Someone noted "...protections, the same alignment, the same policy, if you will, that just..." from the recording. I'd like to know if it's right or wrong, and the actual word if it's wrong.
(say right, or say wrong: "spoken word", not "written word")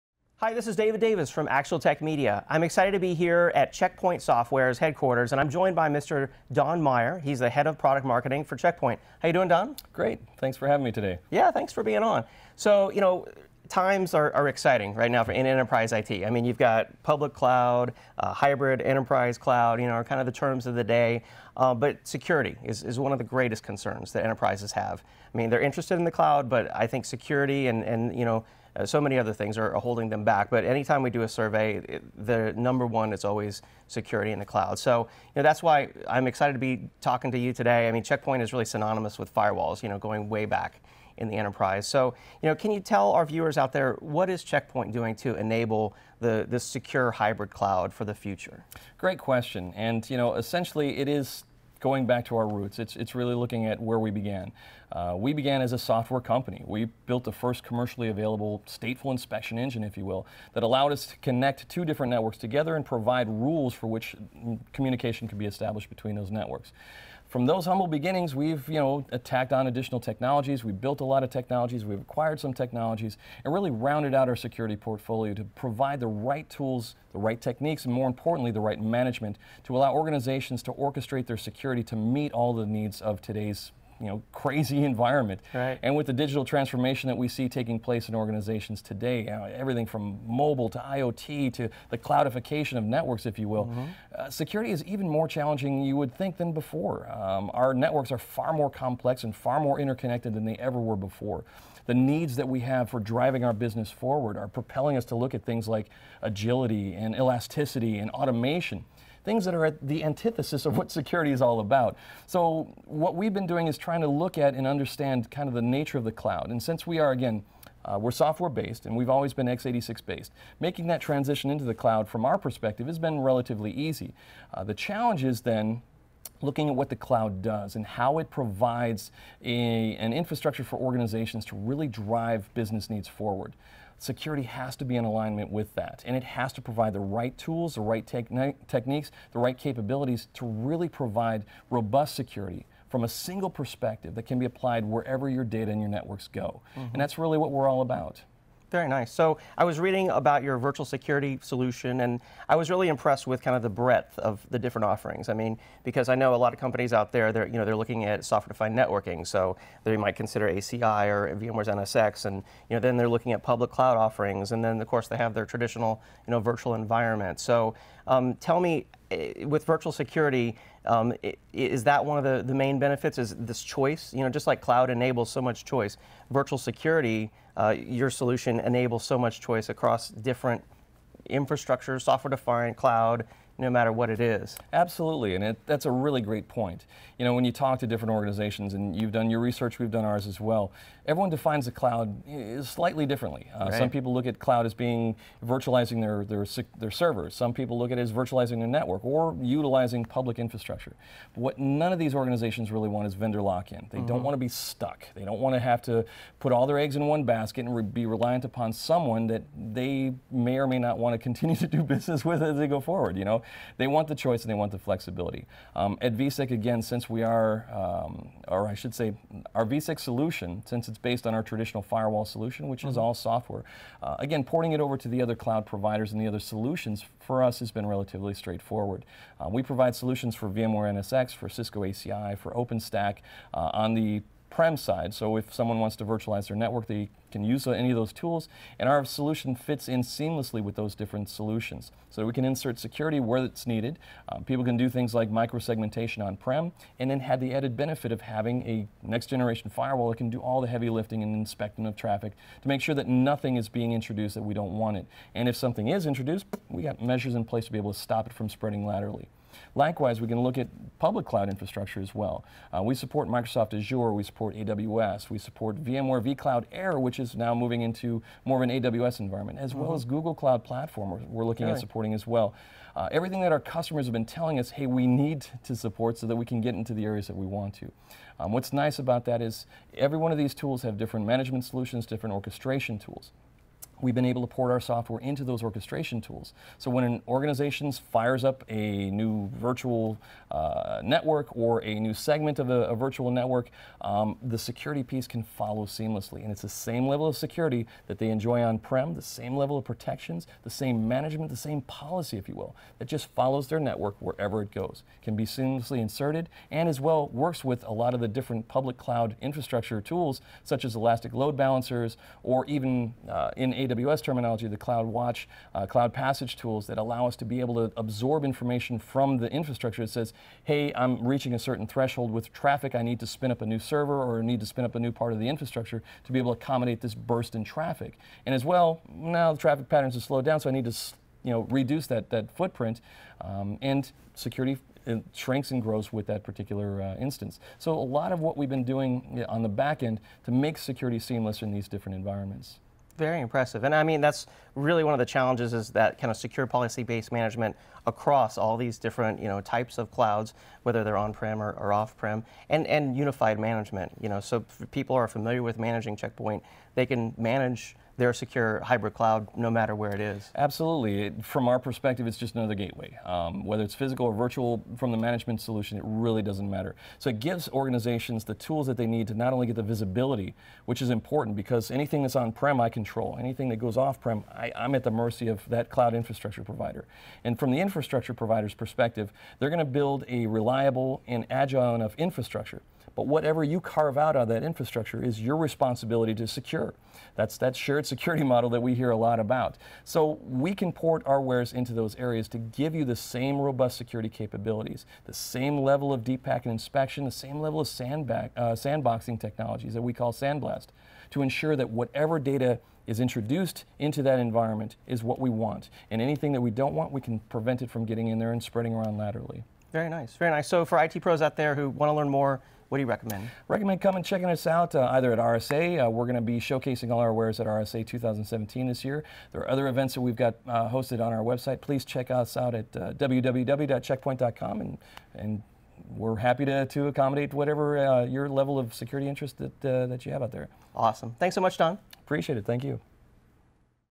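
wrong: "management", not "alignment".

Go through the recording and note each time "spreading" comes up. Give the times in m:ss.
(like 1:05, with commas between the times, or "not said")
4:18, 6:48.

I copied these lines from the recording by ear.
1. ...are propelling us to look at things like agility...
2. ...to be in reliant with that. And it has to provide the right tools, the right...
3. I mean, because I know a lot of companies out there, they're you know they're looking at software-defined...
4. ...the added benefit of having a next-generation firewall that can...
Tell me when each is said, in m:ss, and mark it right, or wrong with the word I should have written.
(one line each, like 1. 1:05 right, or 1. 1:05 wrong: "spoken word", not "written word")
1. 1:44 right
2. 2:14 wrong: "alignment", not "reliant"
3. 2:35 right
4. 4:07 right.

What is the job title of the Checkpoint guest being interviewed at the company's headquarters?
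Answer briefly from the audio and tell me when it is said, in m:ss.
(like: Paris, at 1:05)
Head of product marketing, at 0:07.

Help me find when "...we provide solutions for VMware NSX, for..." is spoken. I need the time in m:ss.
3:49.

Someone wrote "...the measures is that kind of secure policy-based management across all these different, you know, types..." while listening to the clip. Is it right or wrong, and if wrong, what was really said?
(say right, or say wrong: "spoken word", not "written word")
wrong: "challenges", not "measures".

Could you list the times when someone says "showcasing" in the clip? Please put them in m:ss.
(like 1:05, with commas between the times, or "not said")
6:56.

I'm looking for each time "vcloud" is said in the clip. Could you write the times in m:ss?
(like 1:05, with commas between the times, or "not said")
4:26.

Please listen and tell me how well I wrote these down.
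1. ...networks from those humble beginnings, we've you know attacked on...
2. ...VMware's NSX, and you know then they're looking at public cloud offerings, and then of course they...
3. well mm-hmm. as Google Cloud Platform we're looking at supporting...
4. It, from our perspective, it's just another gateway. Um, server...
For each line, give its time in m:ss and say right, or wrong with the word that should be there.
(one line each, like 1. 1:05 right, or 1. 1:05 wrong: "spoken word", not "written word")
1. 1:06 right
2. 2:41 right
3. 4:29 right
4. 6:01 wrong: "whether", not "server".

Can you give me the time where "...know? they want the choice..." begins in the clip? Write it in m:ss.
3:33.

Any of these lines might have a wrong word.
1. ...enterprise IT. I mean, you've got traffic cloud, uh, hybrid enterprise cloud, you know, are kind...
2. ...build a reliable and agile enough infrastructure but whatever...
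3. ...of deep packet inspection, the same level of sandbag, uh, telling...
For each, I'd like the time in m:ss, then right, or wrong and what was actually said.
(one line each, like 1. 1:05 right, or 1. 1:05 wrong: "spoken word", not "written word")
1. 0:15 wrong: "public", not "traffic"
2. 6:19 right
3. 6:36 wrong: "sandboxing", not "telling".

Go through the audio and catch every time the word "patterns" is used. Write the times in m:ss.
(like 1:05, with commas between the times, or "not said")
5:29.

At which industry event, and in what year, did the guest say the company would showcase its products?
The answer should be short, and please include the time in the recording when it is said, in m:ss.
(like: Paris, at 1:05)
RSA 2017, at 6:57.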